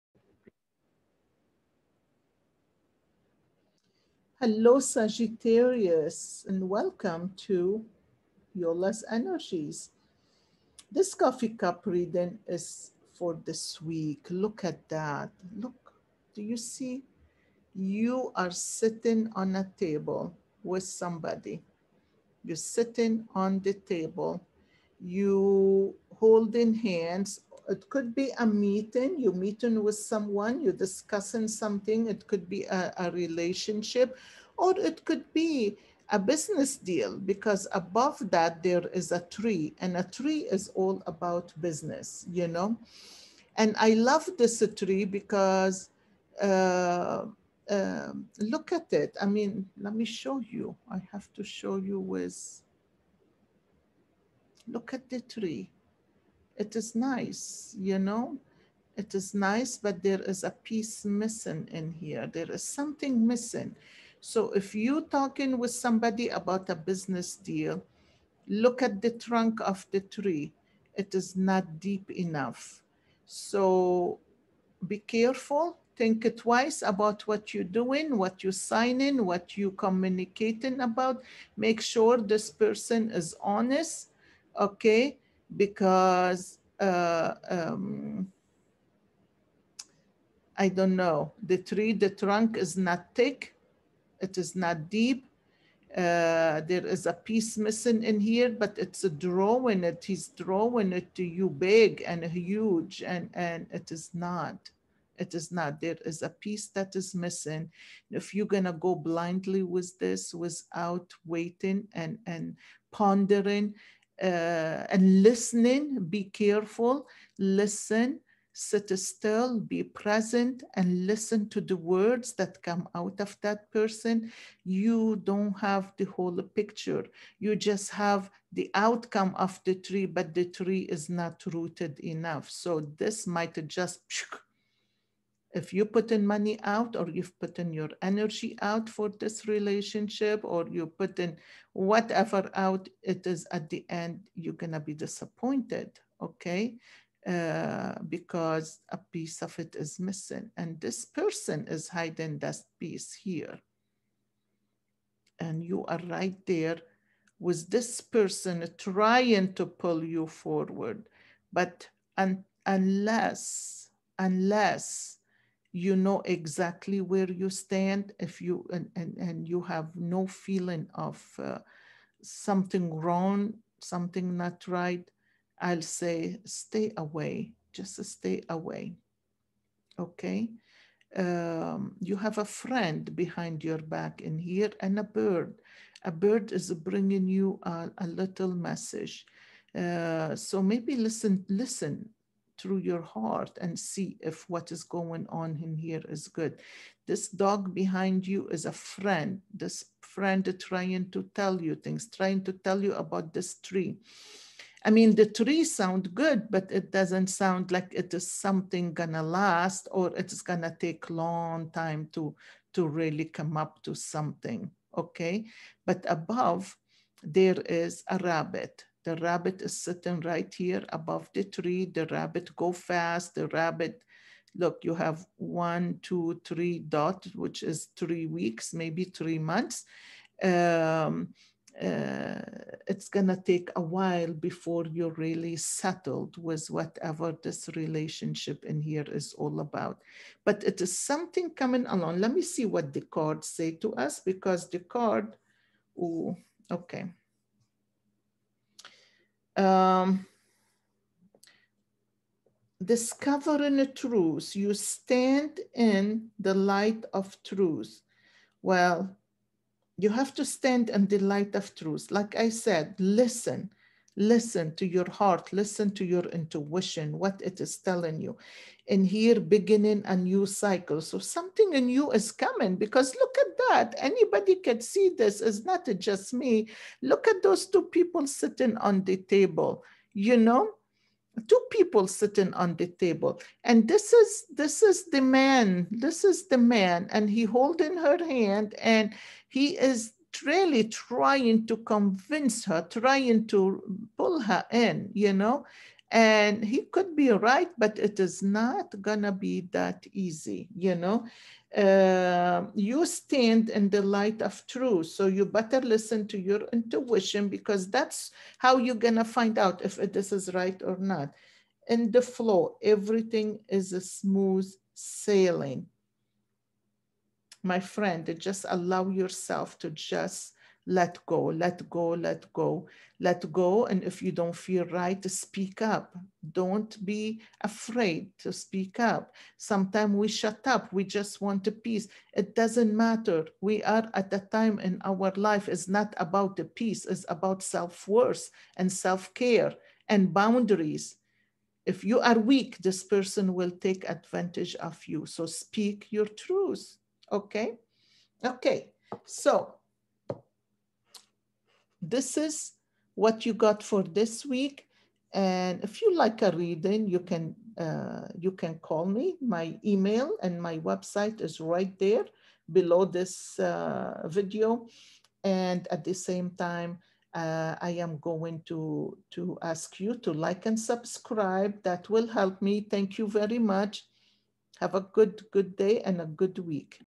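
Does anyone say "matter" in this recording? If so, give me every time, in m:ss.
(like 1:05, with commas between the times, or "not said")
5:32.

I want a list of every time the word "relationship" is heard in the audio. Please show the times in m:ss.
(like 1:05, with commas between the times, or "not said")
0:33, 2:19, 3:57.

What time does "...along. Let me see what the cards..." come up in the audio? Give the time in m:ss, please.
4:01.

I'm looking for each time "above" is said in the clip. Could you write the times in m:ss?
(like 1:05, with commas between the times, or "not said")
0:37, 3:36, 3:40.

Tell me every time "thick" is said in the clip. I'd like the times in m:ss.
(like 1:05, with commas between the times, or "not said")
1:33.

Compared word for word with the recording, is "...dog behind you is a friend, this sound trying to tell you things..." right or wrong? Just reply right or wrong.
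wrong.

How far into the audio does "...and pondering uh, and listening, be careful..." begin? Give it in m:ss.
1:52.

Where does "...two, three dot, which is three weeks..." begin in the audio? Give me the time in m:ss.
3:46.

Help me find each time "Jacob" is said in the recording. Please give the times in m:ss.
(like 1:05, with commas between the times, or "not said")
not said.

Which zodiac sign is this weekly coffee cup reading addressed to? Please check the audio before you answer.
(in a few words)
Sagittarius.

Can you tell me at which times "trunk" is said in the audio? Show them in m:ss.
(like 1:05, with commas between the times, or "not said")
1:09, 1:32.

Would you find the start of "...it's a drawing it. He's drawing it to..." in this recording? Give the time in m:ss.
1:38.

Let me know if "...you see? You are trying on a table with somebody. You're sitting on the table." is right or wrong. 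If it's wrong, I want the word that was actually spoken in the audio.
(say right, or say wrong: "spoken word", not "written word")
wrong: "sitting", not "trying".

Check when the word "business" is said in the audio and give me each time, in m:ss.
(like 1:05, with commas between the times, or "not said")
0:36, 0:41, 1:06.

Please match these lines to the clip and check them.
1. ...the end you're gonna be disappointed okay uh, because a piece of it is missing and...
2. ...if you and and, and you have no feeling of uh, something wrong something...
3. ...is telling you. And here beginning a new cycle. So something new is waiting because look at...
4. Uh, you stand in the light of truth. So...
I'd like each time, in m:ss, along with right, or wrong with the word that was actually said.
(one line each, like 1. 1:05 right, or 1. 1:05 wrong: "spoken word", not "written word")
1. 2:23 right
2. 2:48 right
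3. 4:27 wrong: "coming", not "waiting"
4. 5:01 right.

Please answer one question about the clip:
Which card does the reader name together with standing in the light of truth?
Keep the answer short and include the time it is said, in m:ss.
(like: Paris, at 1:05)
Discovering the truth, at 4:12.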